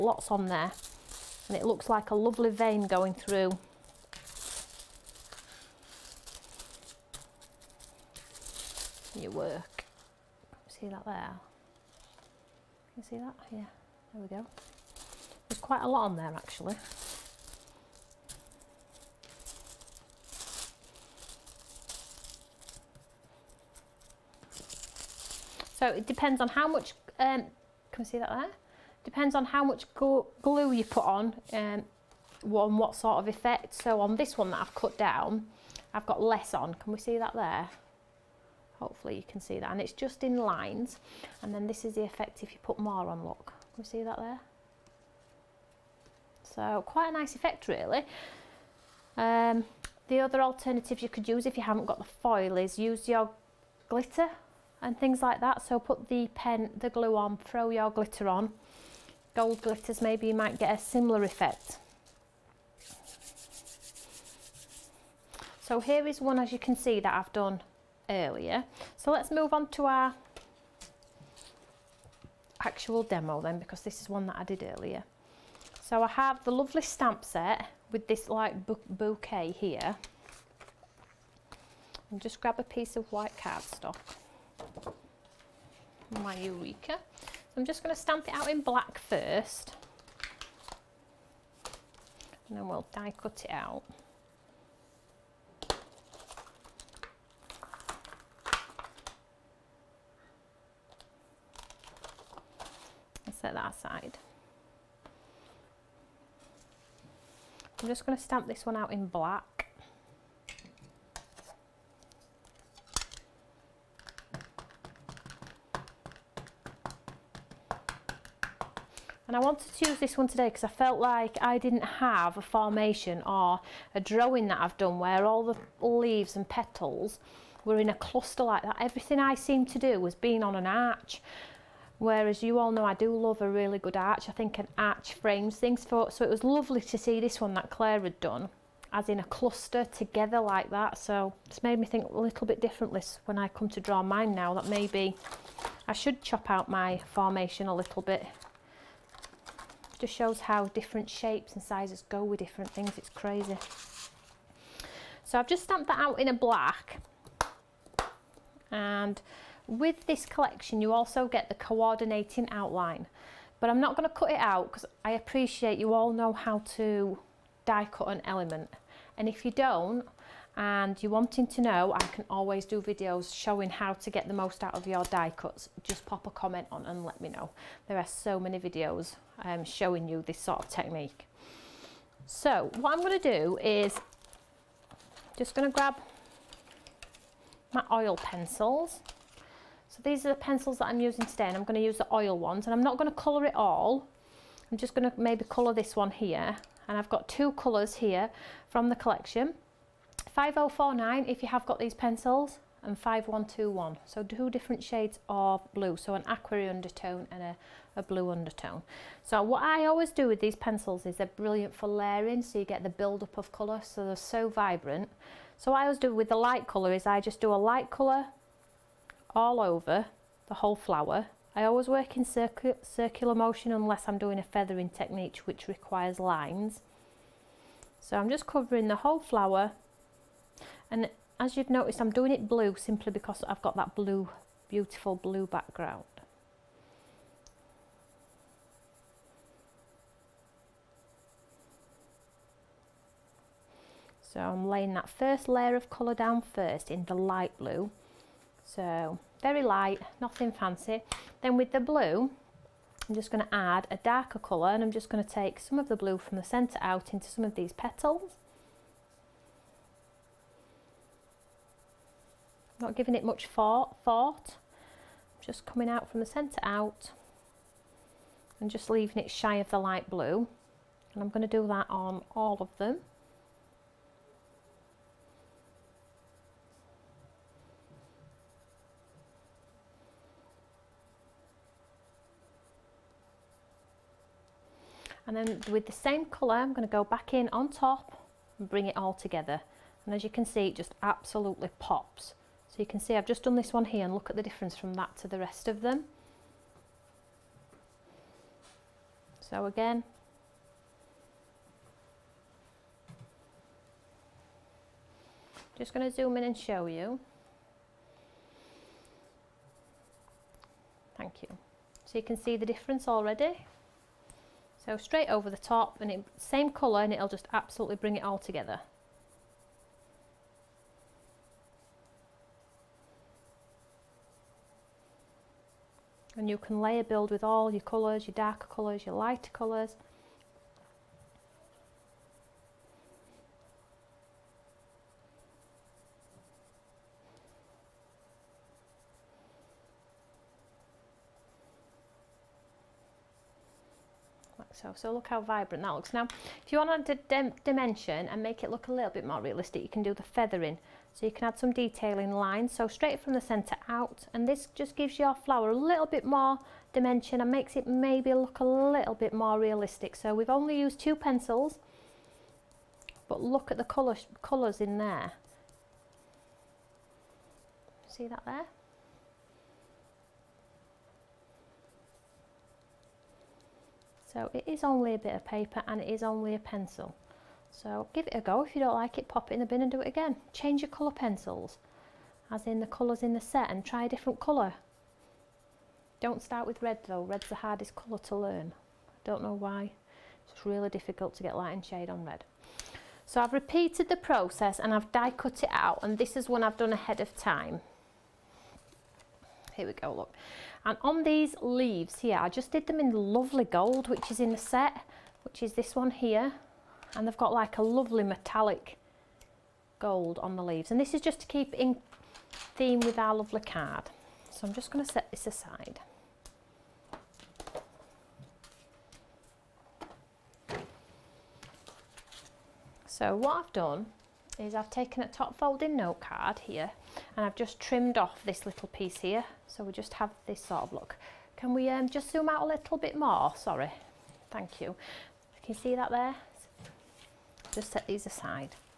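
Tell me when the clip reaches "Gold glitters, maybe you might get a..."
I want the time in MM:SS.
00:59.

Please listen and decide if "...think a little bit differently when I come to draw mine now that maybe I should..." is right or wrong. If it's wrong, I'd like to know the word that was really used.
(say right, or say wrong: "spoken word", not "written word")
right.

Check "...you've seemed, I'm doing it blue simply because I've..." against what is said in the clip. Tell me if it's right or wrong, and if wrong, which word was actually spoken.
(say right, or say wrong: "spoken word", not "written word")
wrong: "noticed", not "seemed".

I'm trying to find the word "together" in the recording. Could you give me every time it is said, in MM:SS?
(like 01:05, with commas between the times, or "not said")
02:19, 04:49, 05:18.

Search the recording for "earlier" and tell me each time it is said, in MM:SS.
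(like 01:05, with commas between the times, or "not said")
01:08, 01:14.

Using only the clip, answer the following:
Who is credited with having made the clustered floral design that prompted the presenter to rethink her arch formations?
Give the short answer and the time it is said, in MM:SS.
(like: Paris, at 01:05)
Claire, at 02:17.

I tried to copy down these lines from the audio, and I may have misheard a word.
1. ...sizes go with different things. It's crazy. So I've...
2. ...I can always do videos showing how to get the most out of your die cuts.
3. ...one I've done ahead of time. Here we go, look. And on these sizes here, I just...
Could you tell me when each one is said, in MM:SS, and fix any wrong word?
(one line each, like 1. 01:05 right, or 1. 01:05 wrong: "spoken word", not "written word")
1. 02:31 right
2. 02:51 right
3. 06:36 wrong: "leaves", not "sizes".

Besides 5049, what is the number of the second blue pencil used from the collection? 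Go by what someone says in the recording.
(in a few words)
5121.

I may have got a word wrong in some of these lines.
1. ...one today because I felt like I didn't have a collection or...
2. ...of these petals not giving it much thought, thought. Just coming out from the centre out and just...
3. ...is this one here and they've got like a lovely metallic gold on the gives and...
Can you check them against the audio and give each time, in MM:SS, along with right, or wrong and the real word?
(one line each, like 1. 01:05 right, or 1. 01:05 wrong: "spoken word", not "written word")
1. 02:00 wrong: "formation", not "collection"
2. 04:17 right
3. 06:45 wrong: "leaves", not "gives".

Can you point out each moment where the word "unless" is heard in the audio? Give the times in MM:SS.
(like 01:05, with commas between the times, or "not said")
03:43.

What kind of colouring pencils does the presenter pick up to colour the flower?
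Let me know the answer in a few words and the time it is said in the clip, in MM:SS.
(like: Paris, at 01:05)
oil pencils, at 03:07.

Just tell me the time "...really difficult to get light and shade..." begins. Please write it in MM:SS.
06:30.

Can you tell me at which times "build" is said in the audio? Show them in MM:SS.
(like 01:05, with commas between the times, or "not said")
03:32, 05:27.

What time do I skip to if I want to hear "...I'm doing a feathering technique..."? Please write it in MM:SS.
03:44.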